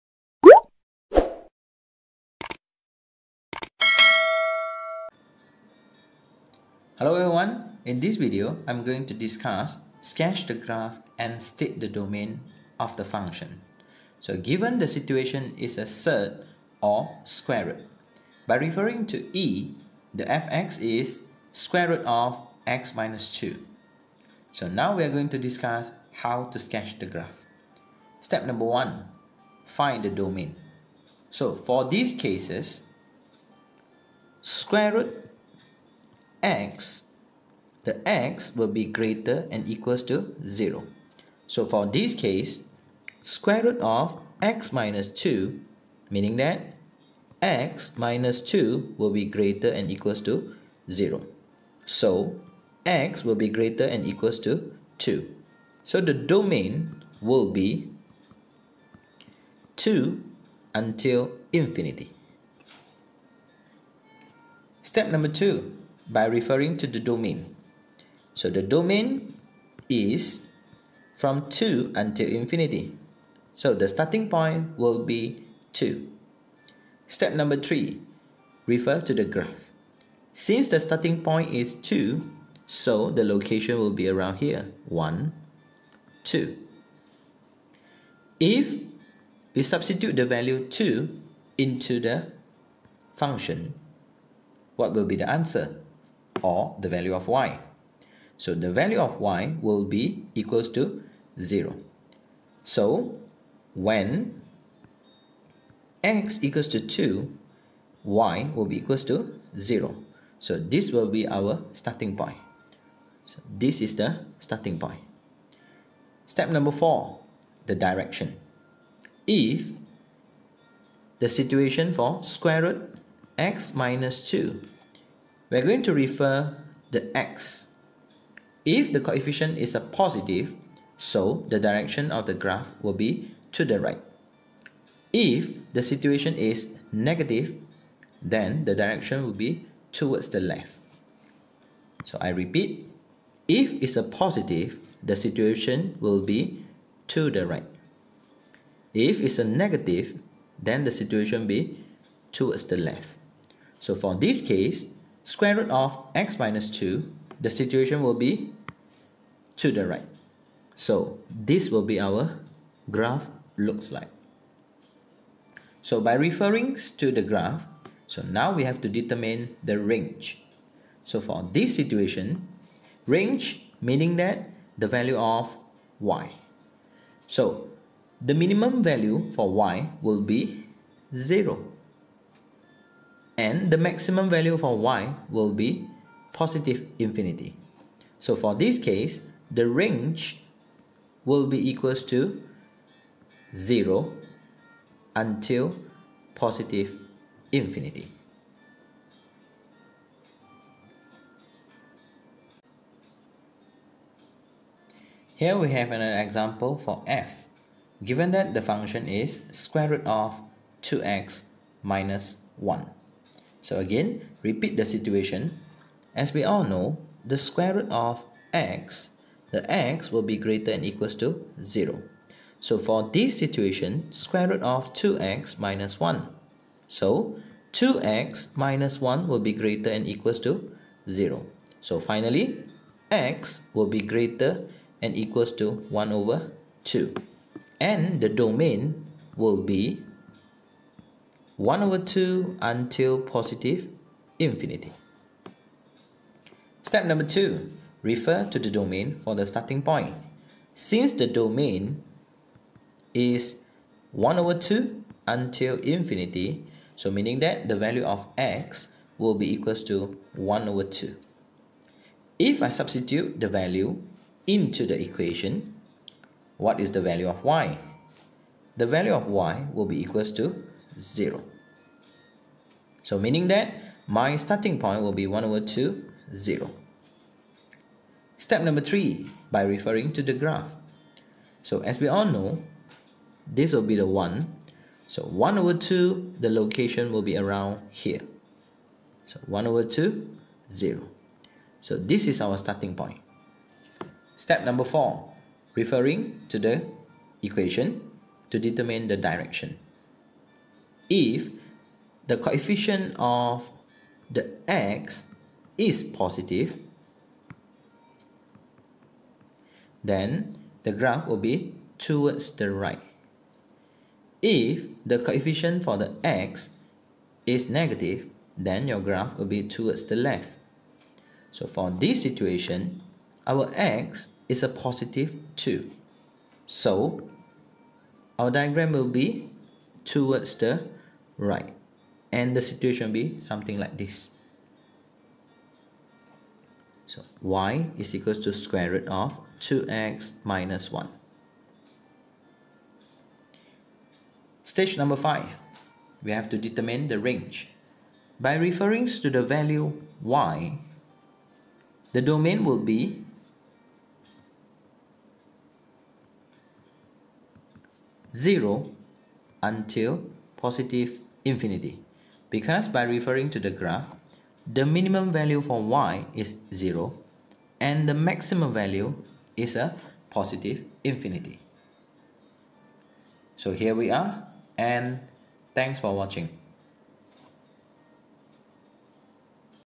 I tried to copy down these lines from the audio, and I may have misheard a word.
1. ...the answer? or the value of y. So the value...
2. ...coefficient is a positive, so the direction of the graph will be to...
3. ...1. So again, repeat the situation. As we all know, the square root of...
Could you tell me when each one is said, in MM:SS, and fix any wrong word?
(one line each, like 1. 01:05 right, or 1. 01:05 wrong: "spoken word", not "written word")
1. 01:35 right
2. 02:09 right
3. 03:32 right.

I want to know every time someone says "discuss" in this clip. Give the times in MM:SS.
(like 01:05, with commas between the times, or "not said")
00:09, 00:25.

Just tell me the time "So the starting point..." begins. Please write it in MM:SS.
01:13.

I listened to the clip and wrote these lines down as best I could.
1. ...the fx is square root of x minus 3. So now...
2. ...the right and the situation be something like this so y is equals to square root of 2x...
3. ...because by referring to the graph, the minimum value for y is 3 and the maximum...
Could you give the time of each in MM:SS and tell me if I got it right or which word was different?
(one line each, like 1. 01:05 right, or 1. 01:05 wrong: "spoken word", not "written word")
1. 00:20 wrong: "2", not "3"
2. 05:30 right
3. 06:02 wrong: "0", not "3".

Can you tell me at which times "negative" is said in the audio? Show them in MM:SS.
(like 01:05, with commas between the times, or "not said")
02:16, 02:29, 05:17.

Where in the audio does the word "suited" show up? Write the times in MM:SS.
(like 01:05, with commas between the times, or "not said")
not said.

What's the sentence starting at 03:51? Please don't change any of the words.
So finally, x will be greater and equals to 1 over 2.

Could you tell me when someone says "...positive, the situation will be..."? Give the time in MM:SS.
02:24.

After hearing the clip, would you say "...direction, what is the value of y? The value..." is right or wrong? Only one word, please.
wrong.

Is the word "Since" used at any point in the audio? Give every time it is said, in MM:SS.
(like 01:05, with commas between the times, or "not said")
01:20, 04:10.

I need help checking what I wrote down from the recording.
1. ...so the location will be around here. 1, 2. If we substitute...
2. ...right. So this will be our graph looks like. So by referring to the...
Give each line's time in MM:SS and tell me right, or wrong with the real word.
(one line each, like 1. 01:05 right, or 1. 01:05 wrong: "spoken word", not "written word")
1. 01:22 right
2. 02:39 right.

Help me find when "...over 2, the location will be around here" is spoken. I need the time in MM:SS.
04:45.